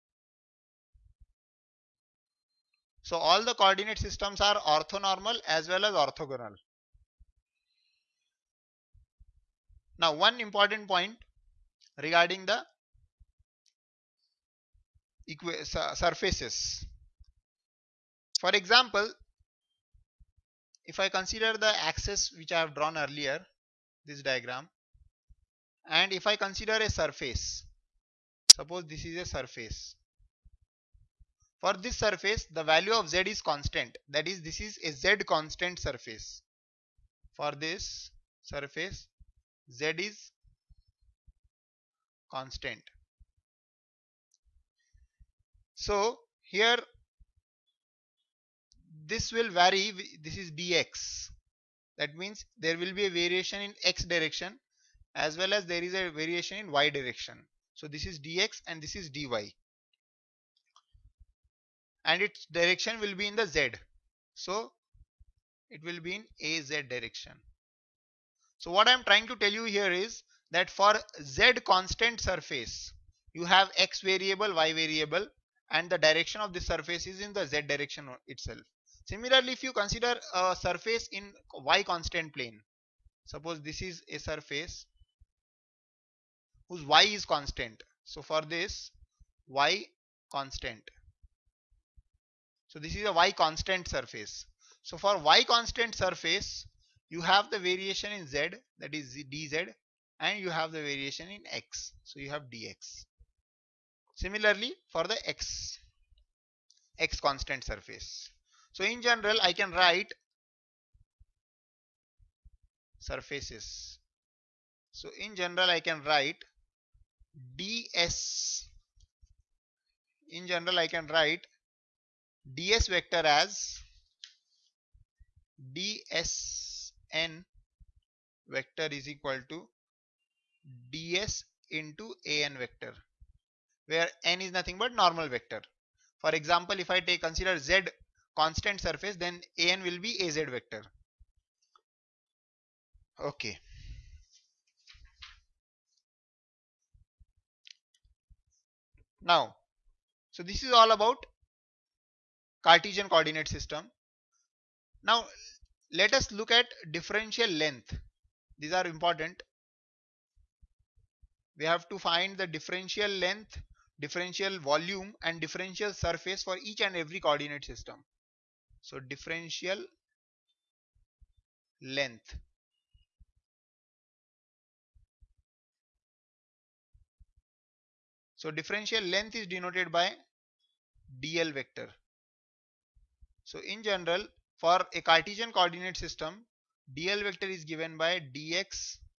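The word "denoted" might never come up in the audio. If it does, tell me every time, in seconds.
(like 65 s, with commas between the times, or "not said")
179 s.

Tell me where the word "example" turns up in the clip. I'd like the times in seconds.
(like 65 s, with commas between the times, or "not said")
18 s, 136 s.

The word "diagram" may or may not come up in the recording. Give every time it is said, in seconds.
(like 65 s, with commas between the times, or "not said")
24 s.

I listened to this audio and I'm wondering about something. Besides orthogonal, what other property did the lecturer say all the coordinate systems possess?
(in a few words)
orthonormal.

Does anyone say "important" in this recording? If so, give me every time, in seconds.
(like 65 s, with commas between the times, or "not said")
10 s, 158 s.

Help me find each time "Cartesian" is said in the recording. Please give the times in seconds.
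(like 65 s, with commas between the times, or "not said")
152 s, 185 s.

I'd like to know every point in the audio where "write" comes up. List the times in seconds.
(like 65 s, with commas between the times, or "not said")
109 s, 116 s, 121 s.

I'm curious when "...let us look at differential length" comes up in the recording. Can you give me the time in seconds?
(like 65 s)
155 s.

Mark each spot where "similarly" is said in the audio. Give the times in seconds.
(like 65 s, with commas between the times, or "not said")
79 s, 104 s.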